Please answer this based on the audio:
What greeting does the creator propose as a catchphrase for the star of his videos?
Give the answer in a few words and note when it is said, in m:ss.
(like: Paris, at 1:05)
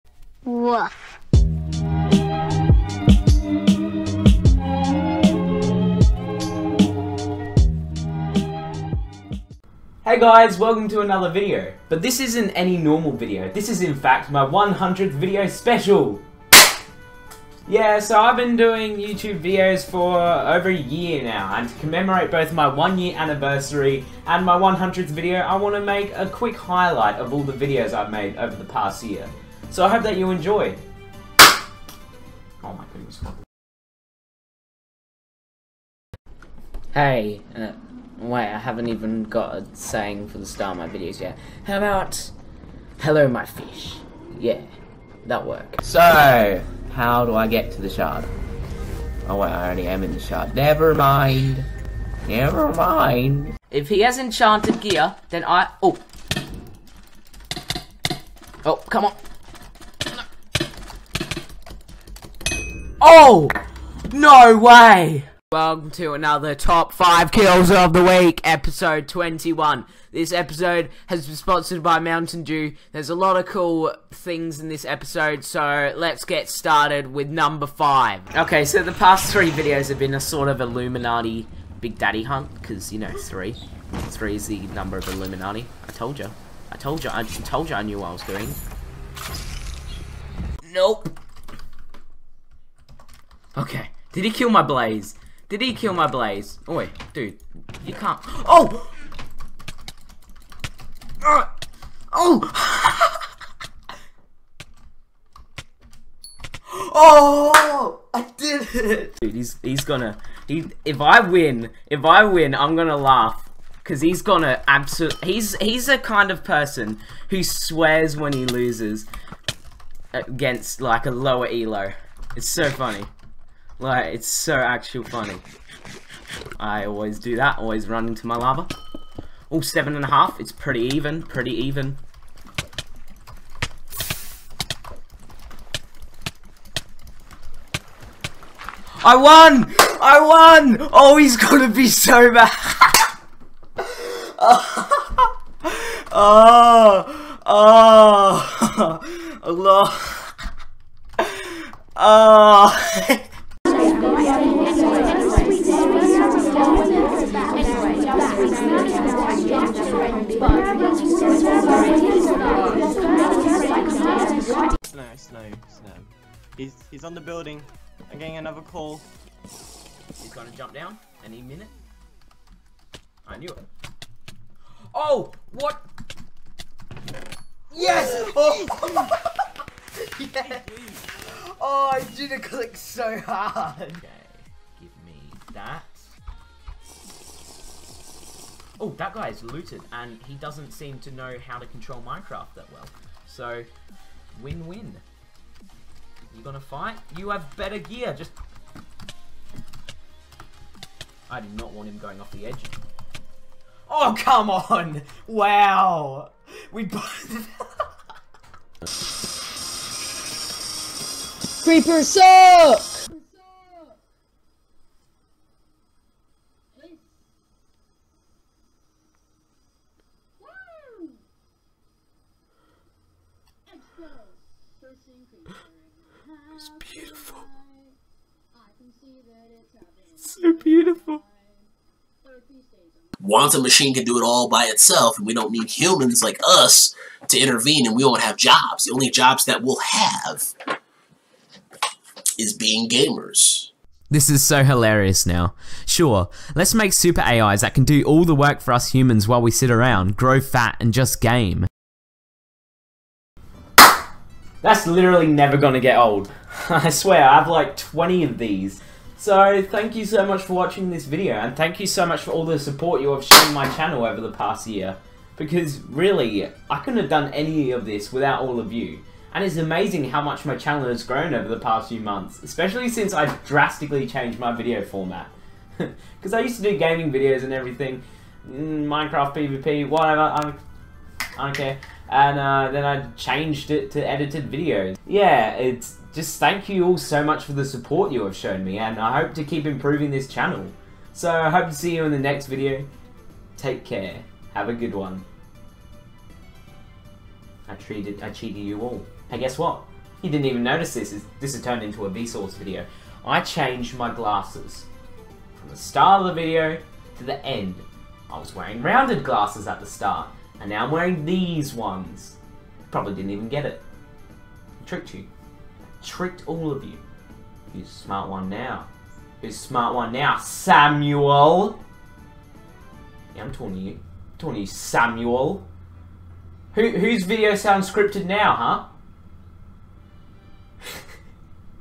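hello my fish, at 0:42.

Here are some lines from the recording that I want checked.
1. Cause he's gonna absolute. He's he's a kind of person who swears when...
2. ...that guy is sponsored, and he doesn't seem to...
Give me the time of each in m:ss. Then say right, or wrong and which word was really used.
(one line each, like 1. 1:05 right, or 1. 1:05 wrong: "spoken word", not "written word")
1. 1:53 right
2. 3:08 wrong: "looted", not "sponsored".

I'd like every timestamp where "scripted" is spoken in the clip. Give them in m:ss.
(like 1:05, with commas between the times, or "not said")
5:27.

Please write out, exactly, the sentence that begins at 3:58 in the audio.
The only jobs that we'll have is being gamers.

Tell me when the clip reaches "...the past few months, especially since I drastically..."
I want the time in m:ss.
4:31.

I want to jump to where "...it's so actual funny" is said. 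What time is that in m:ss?
2:04.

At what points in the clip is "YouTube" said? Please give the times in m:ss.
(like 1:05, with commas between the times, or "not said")
0:18.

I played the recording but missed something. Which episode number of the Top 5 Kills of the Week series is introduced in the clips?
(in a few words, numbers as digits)
21.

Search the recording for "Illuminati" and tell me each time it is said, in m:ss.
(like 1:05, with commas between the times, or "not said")
1:20, 1:25.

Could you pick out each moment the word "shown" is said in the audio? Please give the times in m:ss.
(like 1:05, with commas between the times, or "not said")
4:23, 4:48.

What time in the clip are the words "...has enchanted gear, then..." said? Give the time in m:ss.
0:54.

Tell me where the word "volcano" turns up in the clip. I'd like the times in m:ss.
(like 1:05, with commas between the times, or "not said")
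not said.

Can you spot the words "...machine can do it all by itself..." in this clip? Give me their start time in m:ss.
3:53.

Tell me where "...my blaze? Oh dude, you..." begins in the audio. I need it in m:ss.
1:35.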